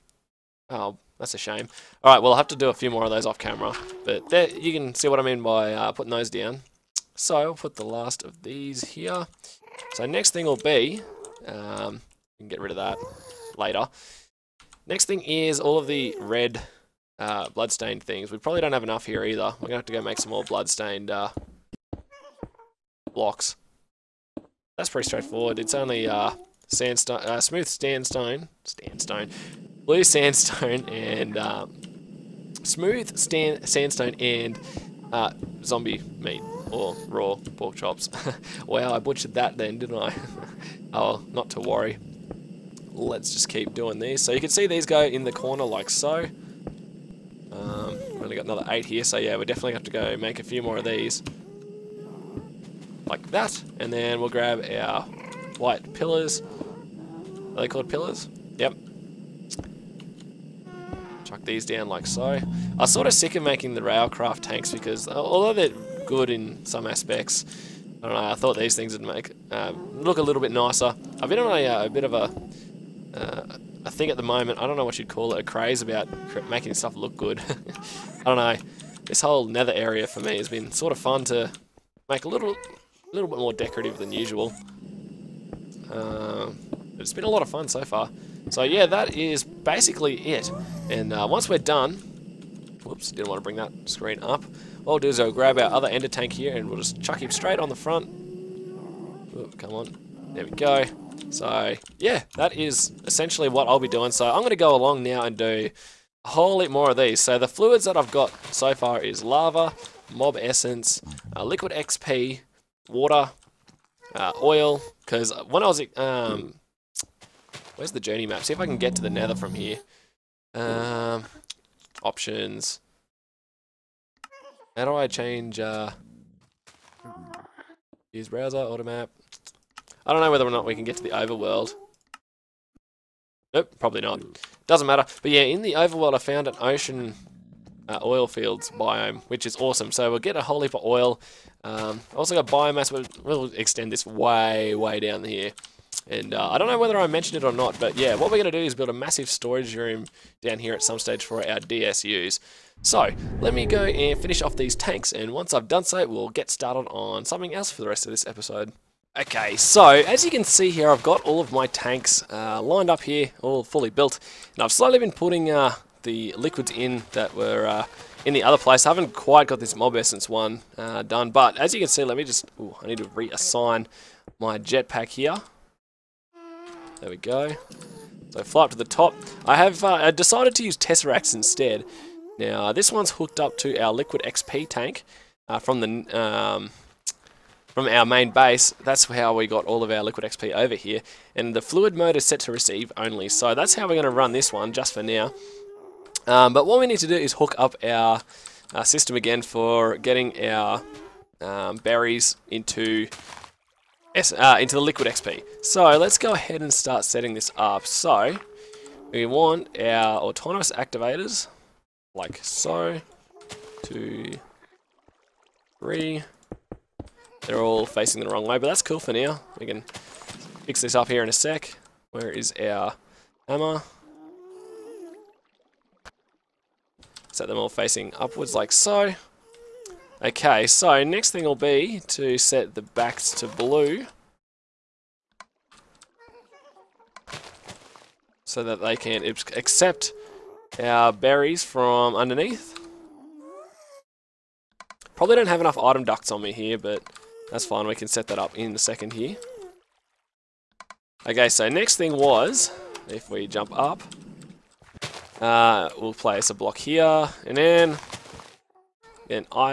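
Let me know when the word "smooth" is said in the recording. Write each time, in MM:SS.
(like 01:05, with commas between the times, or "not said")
00:27, 00:32.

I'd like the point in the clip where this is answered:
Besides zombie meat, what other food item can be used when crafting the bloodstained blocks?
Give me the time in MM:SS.
00:37.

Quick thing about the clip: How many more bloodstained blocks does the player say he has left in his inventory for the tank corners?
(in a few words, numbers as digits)
8.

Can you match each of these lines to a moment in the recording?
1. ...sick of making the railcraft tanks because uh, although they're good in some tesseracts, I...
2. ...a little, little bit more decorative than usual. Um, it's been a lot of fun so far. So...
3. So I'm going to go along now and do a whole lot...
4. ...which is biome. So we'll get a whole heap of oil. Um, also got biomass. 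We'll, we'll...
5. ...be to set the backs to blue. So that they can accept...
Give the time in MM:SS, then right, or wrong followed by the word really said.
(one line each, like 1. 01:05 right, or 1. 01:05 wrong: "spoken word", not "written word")
1. 01:03 wrong: "aspects", not "tesseracts"
2. 01:22 right
3. 01:44 right
4. 02:19 wrong: "awesome", not "biome"
5. 03:51 right.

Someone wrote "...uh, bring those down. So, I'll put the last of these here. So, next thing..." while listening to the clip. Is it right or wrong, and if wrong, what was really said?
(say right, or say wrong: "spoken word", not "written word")
wrong: "putting", not "bring".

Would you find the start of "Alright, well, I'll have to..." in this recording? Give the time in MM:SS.
00:02.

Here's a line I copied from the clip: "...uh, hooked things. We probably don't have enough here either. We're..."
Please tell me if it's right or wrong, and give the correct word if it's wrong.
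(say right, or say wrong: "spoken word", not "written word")
wrong: "bloodstained", not "hooked".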